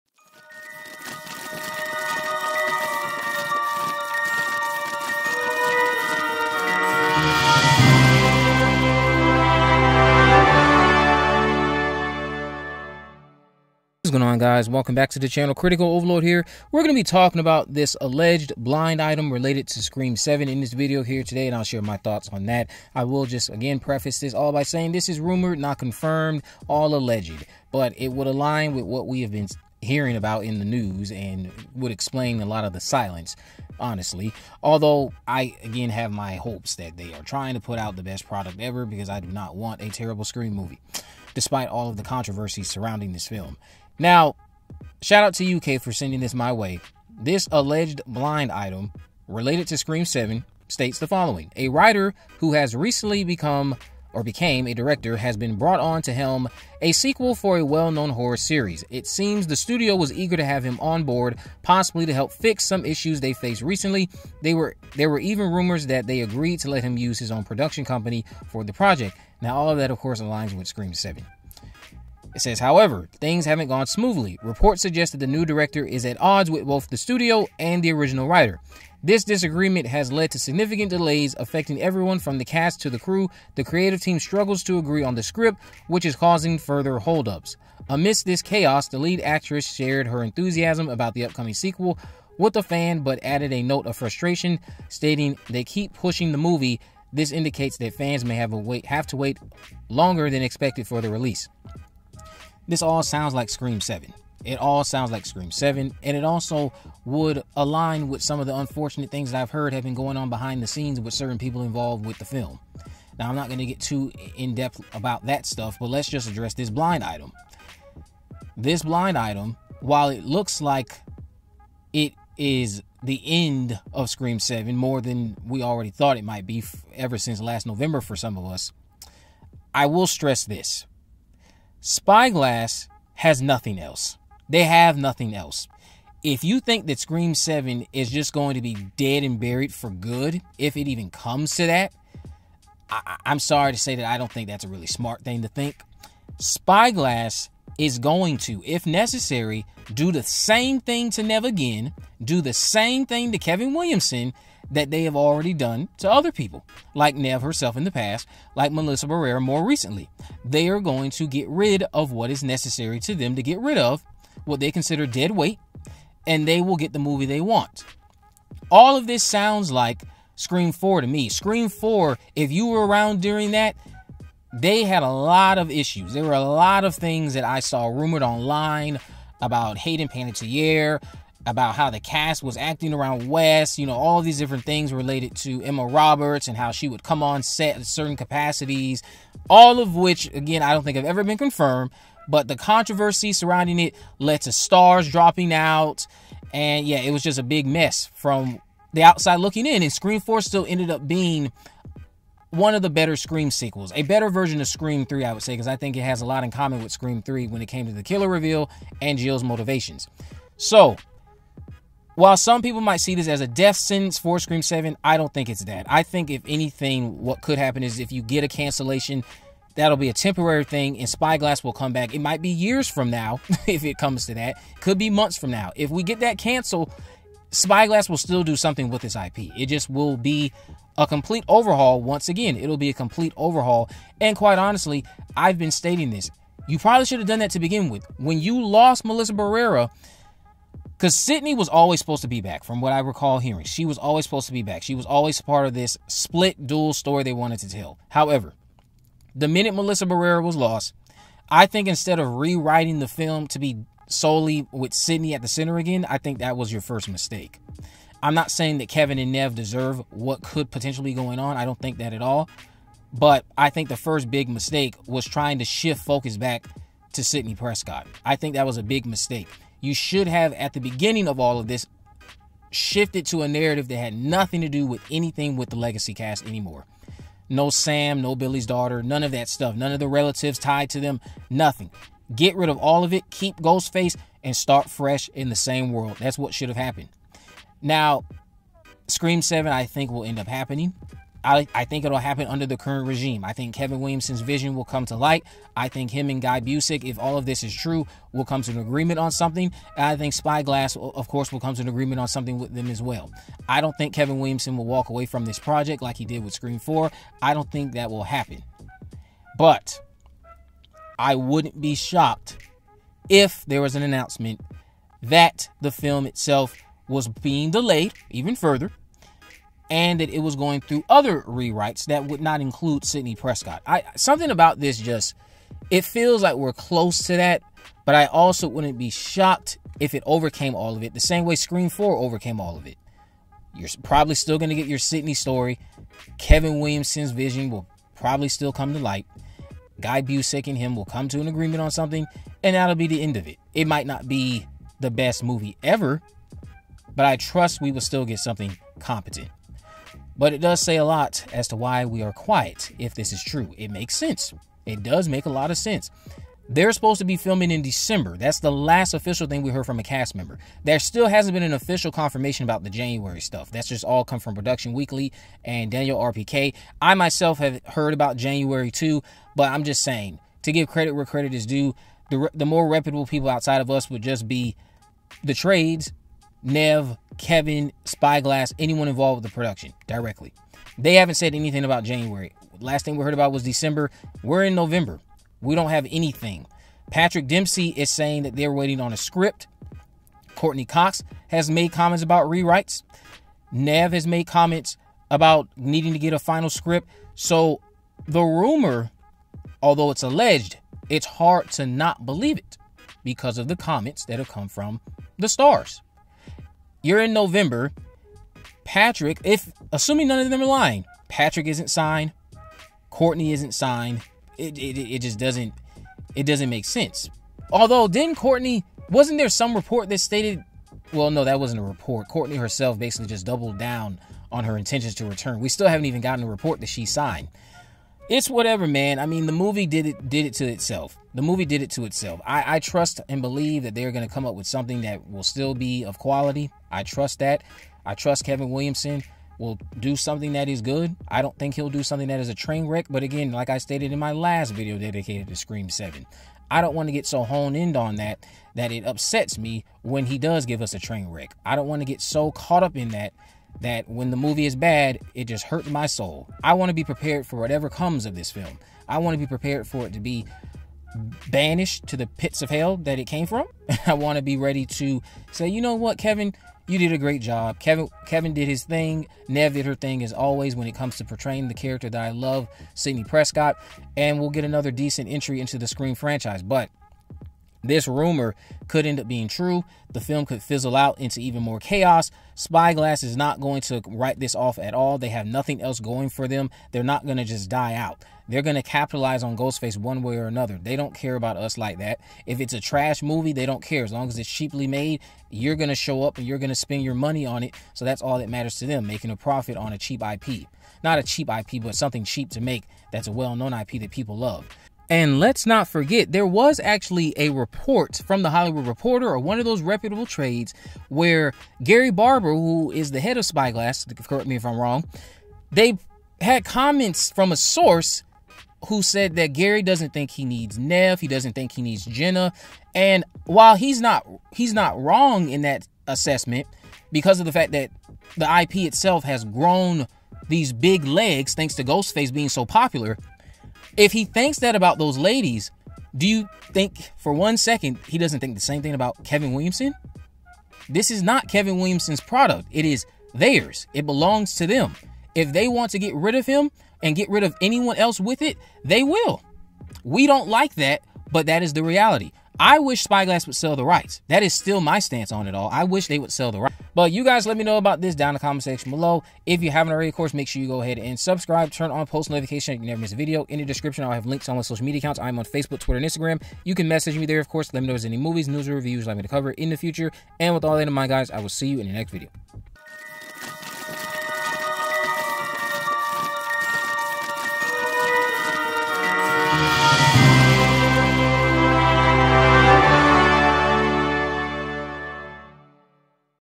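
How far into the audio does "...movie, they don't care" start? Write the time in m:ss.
8:13.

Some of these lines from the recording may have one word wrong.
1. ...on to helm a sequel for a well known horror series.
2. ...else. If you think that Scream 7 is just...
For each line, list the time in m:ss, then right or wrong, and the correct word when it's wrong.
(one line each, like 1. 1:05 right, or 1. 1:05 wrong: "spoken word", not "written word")
1. 0:55 right
2. 2:15 right.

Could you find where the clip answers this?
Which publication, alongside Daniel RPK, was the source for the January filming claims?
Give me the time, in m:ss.
6:04.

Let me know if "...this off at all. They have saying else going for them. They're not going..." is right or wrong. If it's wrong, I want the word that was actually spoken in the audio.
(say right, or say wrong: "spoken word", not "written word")
wrong: "nothing", not "saying".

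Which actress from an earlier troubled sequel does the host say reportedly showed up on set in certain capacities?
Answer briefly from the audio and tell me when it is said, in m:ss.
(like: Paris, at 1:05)
Emma Roberts, at 3:05.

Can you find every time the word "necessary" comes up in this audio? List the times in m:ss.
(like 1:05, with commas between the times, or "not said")
2:28, 2:42.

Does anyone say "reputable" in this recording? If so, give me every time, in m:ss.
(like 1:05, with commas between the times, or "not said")
6:12, 8:29.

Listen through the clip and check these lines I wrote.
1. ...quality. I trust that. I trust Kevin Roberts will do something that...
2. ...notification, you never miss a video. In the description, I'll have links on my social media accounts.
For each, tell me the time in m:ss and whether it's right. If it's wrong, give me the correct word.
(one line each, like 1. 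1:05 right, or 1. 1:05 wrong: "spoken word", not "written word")
1. 7:16 wrong: "Williamson", not "Roberts"
2. 9:22 right.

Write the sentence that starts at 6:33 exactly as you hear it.
Neve has made comments about needing to get a final script.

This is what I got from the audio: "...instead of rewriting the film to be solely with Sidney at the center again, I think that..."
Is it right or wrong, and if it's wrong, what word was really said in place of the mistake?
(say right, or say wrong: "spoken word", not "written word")
right.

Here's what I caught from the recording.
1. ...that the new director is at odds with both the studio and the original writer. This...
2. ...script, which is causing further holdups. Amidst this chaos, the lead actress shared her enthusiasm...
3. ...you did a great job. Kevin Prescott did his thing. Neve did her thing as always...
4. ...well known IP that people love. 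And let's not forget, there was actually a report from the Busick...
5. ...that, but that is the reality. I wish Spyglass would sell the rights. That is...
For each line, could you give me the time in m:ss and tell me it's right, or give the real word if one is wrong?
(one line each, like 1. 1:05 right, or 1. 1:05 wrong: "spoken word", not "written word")
1. 1:15 right
2. 1:25 right
3. 7:46 wrong: "Kevin", not "Prescott"
4. 8:23 wrong: "Hollywood", not "Busick"
5. 9:10 right.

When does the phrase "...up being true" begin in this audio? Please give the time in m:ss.
7:59.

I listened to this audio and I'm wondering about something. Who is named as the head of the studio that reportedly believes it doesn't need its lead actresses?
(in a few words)
Gary Barber.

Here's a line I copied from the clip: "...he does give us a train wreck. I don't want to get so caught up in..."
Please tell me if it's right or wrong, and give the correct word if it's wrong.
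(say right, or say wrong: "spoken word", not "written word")
right.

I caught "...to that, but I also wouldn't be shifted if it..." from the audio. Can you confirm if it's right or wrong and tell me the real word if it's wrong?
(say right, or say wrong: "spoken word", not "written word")
wrong: "shocked", not "shifted".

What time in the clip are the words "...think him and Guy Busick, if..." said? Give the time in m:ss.
4:55.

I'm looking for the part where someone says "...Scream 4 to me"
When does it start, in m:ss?
2:50.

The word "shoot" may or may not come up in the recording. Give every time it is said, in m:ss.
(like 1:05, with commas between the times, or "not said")
not said.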